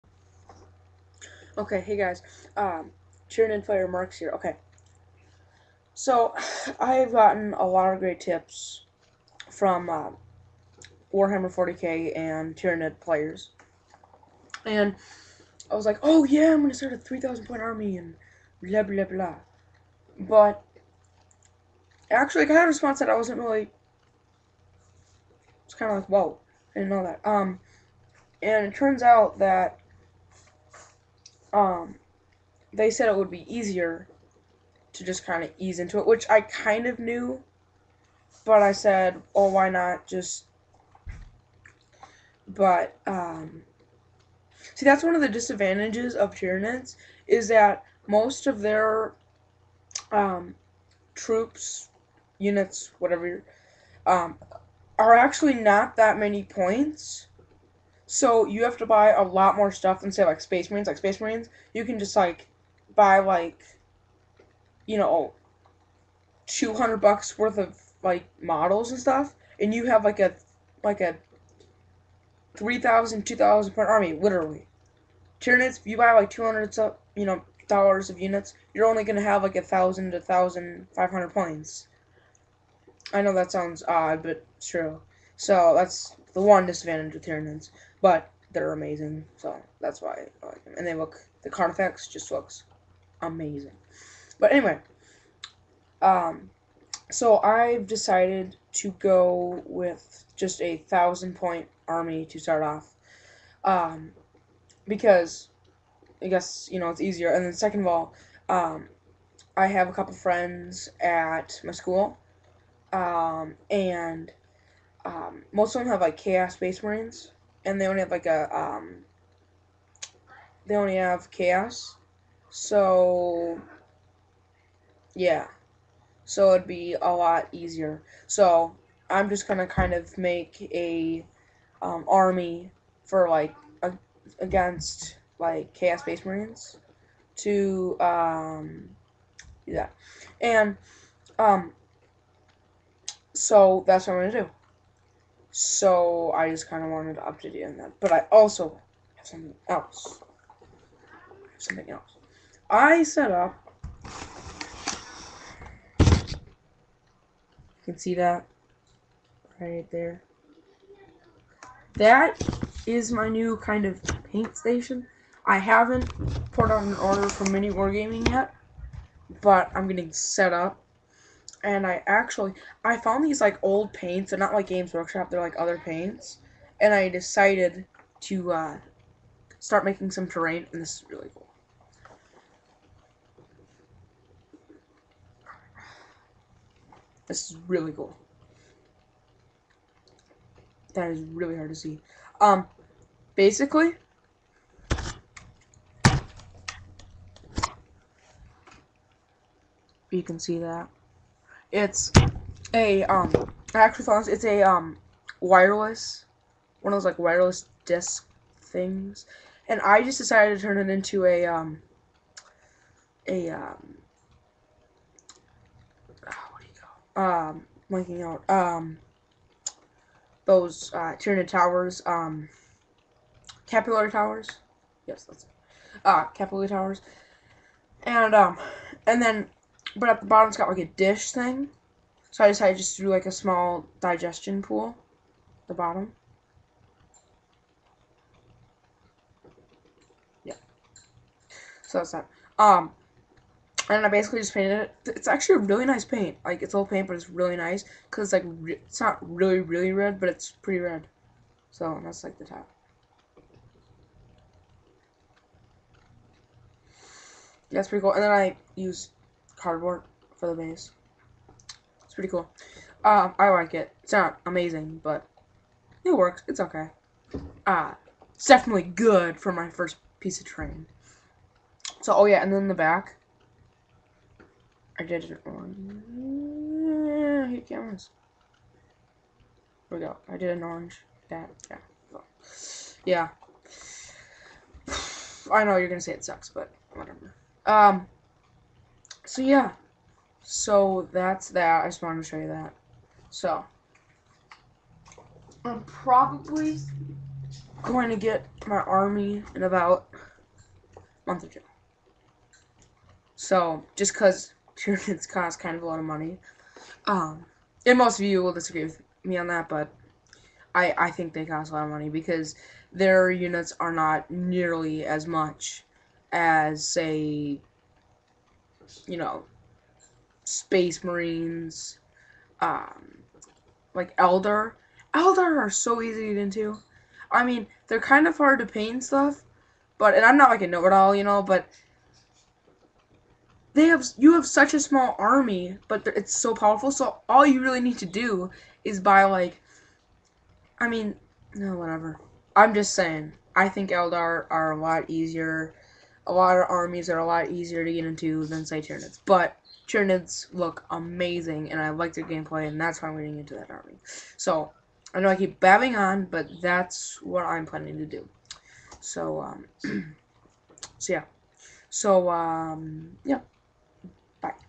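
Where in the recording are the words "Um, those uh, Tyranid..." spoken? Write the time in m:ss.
3:38.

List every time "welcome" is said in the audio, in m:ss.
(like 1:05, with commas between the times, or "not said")
not said.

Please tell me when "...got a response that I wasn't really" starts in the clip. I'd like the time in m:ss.
0:22.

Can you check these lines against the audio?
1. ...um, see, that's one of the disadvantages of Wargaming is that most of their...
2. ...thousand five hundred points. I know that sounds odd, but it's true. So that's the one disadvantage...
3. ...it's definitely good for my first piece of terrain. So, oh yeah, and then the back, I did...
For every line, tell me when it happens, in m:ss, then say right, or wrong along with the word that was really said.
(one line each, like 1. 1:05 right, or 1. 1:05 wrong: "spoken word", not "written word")
1. 0:43 wrong: "Tyranids", not "Wargaming"
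2. 1:20 right
3. 4:28 right.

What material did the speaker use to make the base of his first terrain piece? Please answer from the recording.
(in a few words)
Cardboard.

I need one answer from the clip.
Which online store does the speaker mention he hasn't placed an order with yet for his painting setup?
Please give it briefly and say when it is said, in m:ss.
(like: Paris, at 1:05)
Mini Wargaming, at 2:47.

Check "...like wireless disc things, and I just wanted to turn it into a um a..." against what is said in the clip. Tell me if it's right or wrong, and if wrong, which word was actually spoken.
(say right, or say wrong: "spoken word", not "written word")
wrong: "decided", not "wanted".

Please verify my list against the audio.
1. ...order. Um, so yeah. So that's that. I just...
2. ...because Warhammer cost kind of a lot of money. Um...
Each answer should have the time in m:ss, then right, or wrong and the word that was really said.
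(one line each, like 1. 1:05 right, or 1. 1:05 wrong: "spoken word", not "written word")
1. 4:46 wrong: "whatever", not "order"
2. 5:04 wrong: "Tyranids", not "Warhammer".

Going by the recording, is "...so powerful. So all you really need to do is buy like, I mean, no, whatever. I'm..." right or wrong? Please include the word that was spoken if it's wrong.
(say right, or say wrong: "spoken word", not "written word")
right.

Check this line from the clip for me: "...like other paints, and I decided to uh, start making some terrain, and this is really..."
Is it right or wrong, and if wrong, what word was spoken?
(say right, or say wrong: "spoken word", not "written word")
right.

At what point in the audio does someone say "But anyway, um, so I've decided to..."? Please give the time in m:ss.
1:34.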